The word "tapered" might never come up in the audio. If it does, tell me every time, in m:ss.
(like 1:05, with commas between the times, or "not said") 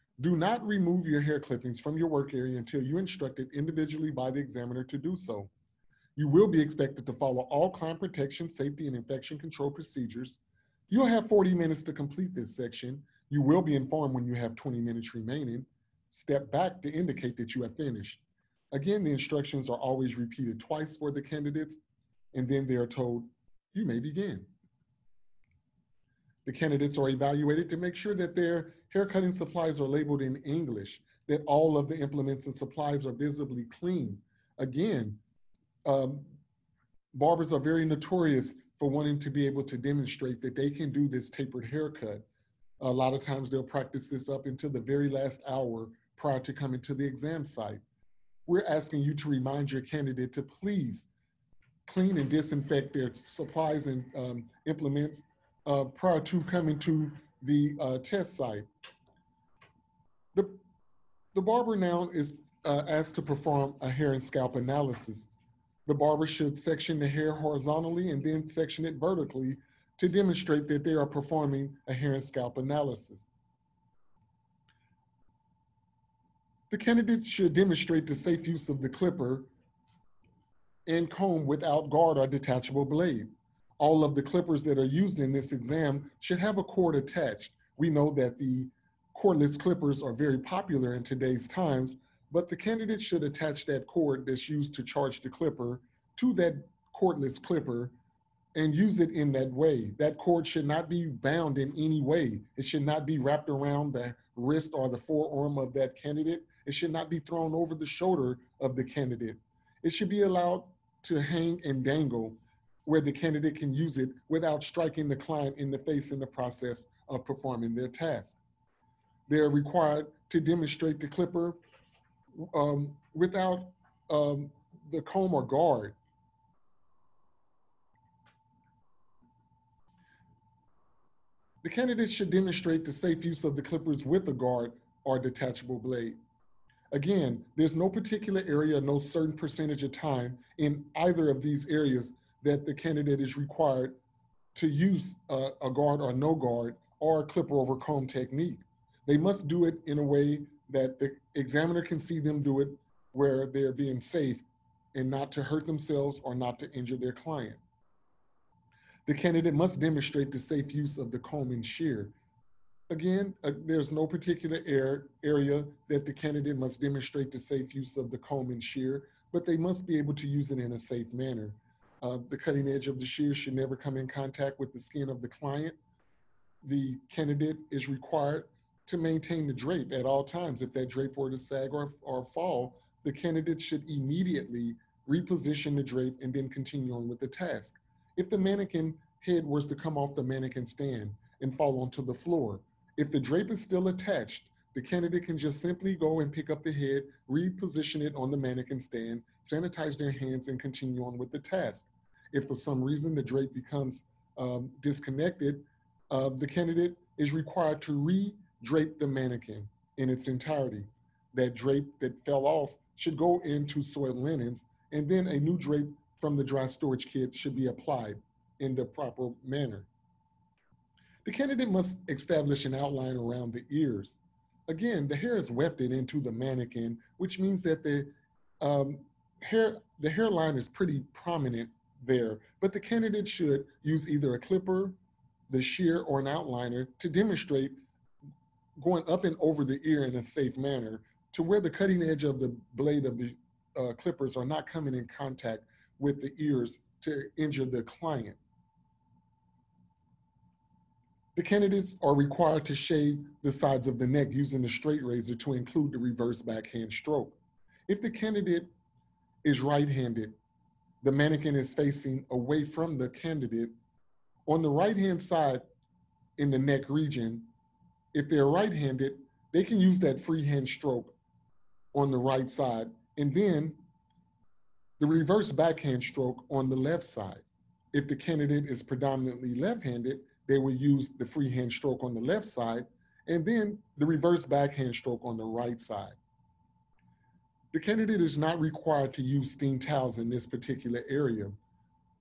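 0:41.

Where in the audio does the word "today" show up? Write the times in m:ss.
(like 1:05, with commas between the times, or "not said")
1:31.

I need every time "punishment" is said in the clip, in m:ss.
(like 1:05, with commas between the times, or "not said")
not said.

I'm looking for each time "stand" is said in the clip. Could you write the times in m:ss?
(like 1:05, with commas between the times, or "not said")
3:10, 3:18.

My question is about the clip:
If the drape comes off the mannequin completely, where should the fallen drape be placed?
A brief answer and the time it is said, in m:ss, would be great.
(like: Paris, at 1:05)
soiled linens, at 3:33.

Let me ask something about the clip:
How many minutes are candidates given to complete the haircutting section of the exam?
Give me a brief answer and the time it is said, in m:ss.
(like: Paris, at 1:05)
40 minutes, at 0:11.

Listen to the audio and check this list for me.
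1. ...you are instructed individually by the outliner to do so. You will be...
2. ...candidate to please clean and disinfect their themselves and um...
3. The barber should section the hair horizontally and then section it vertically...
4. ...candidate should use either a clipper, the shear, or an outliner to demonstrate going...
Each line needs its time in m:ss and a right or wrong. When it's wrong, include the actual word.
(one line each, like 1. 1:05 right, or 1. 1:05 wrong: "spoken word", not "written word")
1. 0:02 wrong: "examiner", not "outliner"
2. 0:49 wrong: "supplies", not "themselves"
3. 1:05 right
4. 3:52 right.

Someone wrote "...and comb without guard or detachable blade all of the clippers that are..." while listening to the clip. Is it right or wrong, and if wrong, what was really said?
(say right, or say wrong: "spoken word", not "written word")
right.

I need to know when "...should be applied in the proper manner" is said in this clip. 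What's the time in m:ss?
3:37.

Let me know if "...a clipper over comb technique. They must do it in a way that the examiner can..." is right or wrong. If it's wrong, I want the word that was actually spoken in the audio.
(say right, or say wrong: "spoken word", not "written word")
right.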